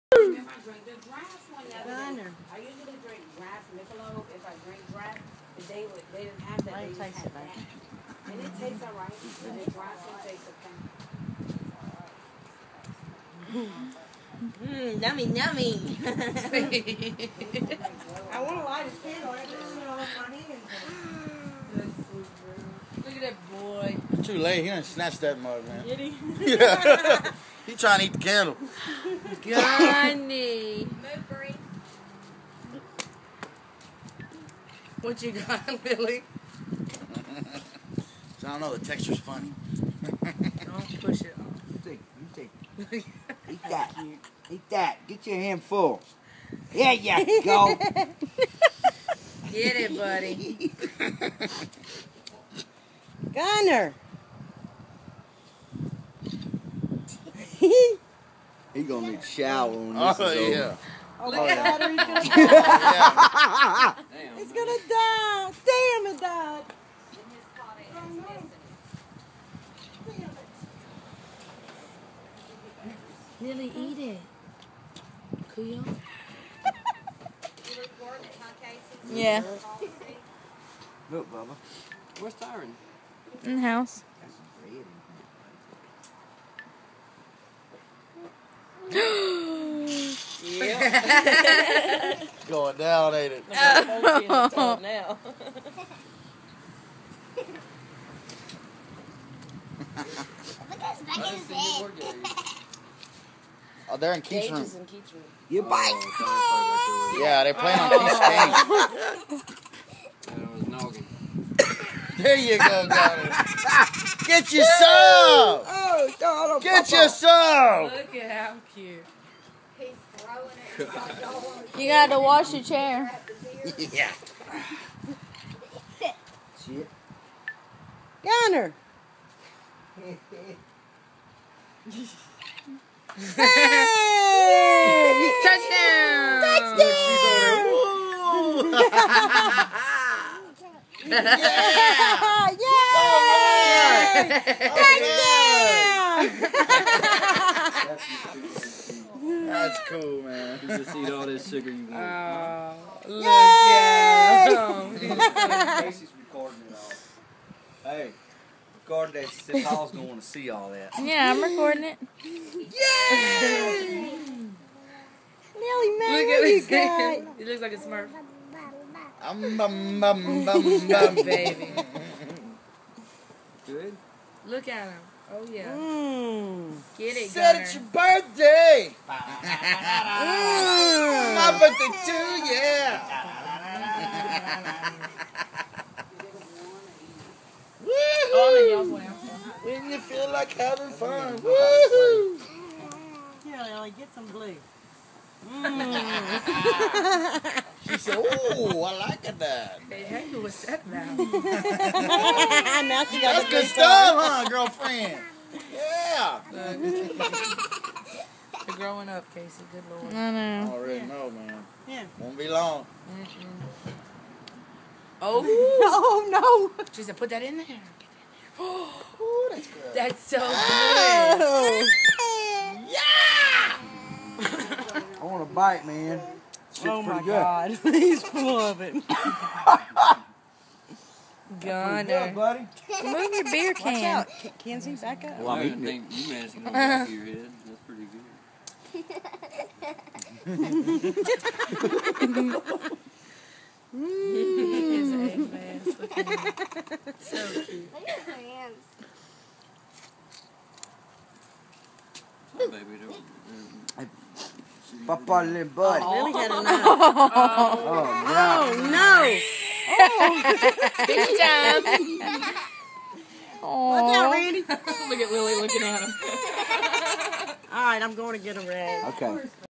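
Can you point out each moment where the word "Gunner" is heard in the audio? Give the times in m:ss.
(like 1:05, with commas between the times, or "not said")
0:53, 2:57, 3:51.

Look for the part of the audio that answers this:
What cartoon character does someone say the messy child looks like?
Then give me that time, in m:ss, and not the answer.
2:47.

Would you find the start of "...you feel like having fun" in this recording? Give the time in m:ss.
3:09.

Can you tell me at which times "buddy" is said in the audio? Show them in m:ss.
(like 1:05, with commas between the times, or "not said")
0:49, 3:52, 4:15.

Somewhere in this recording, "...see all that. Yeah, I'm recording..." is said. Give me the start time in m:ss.
2:40.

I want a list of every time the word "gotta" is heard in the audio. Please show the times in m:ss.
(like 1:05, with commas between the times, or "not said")
2:01.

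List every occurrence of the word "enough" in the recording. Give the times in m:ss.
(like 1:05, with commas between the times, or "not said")
4:16.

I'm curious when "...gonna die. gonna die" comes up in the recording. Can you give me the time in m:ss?
1:04.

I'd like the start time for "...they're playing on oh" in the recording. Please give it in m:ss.
1:47.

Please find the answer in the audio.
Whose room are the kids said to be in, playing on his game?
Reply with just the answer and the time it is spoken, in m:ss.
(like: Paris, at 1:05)
Keith's room, at 1:44.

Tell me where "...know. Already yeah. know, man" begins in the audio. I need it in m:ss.
3:30.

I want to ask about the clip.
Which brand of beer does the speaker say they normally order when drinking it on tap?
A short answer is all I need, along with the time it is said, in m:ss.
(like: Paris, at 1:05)
Michelob, at 0:03.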